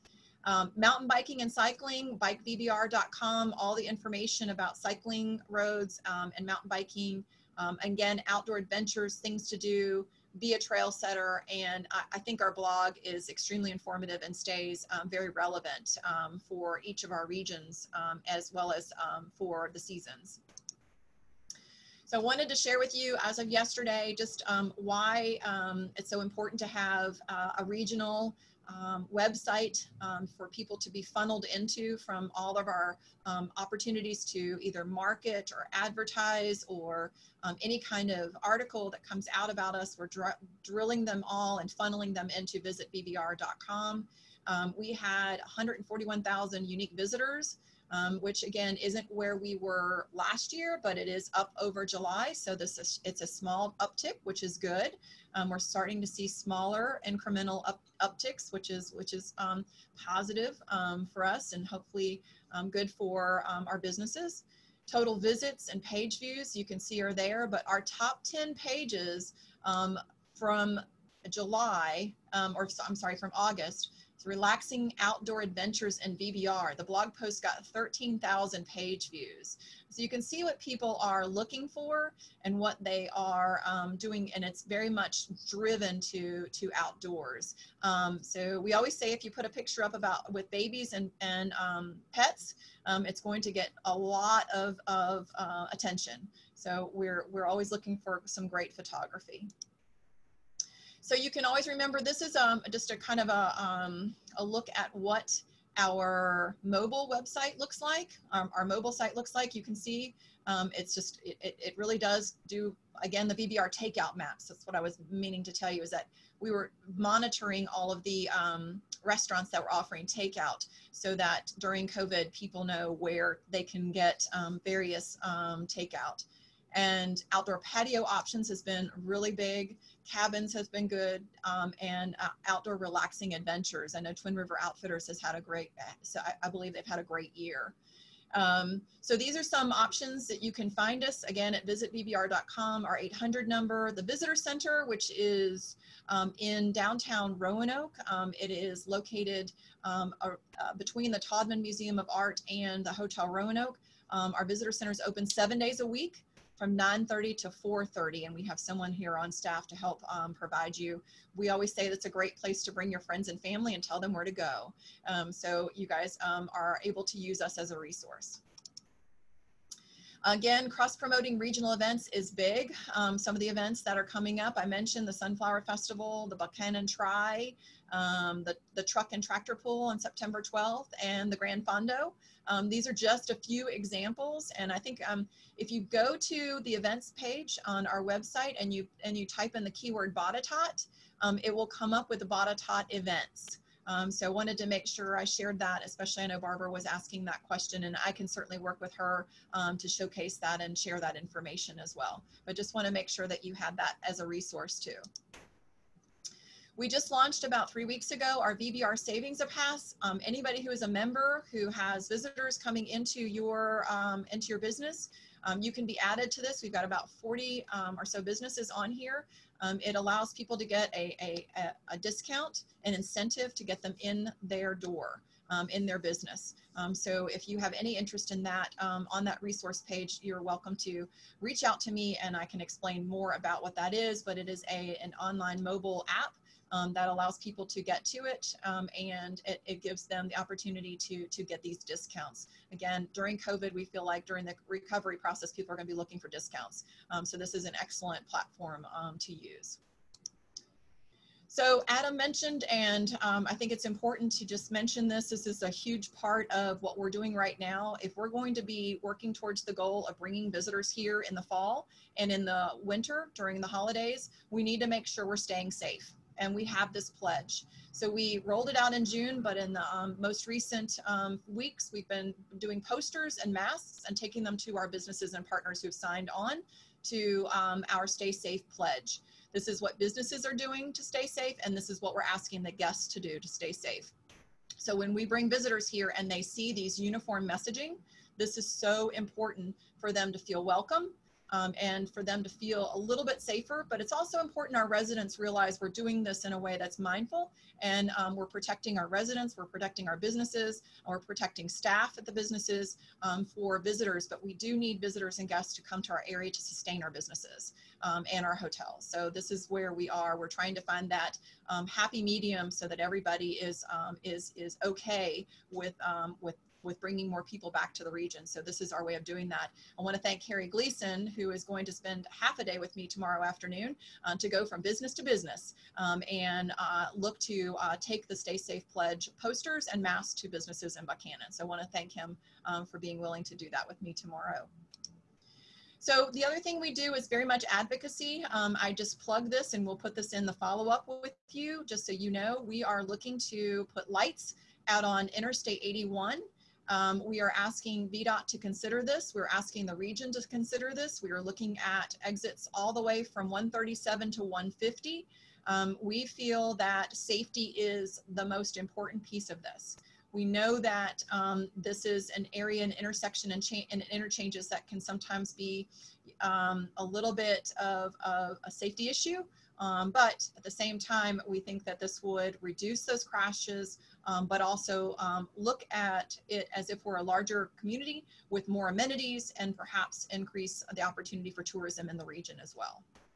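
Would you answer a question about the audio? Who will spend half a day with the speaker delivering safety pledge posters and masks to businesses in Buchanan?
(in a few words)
Harry Gleason.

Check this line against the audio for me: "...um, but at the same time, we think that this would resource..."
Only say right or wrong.
wrong.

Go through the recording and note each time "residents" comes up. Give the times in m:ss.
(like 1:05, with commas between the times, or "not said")
4:54, 4:59.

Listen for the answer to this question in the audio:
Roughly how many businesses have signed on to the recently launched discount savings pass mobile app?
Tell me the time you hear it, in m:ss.
3:37.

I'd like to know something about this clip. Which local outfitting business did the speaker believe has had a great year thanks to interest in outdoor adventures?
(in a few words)
Twin River Outfitters.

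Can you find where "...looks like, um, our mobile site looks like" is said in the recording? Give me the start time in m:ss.
1:47.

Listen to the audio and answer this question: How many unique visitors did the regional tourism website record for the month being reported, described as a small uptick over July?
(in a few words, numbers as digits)
141,000.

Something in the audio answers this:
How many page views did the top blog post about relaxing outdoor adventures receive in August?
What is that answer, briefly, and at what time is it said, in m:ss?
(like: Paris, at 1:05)
13,000, at 1:17.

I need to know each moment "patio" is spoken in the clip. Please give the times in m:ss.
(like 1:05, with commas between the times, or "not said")
2:07.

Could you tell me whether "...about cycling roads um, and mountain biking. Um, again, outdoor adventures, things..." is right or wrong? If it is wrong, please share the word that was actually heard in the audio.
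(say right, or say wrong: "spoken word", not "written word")
right.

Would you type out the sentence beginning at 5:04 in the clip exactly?
But we do need visitors and guests to come to our area to sustain our businesses um, and our hotels.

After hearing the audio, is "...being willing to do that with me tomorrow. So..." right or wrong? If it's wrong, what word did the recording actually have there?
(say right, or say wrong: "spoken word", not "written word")
right.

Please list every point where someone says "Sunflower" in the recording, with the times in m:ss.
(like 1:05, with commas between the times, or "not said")
2:55.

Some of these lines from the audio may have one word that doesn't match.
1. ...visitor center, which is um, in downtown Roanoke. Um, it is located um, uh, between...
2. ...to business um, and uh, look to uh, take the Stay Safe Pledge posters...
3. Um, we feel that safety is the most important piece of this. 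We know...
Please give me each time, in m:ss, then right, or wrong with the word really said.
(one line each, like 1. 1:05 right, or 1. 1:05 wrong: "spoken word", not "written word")
1. 2:24 right
2. 5:25 right
3. 5:55 right.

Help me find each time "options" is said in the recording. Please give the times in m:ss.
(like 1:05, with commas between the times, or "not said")
2:08, 2:19.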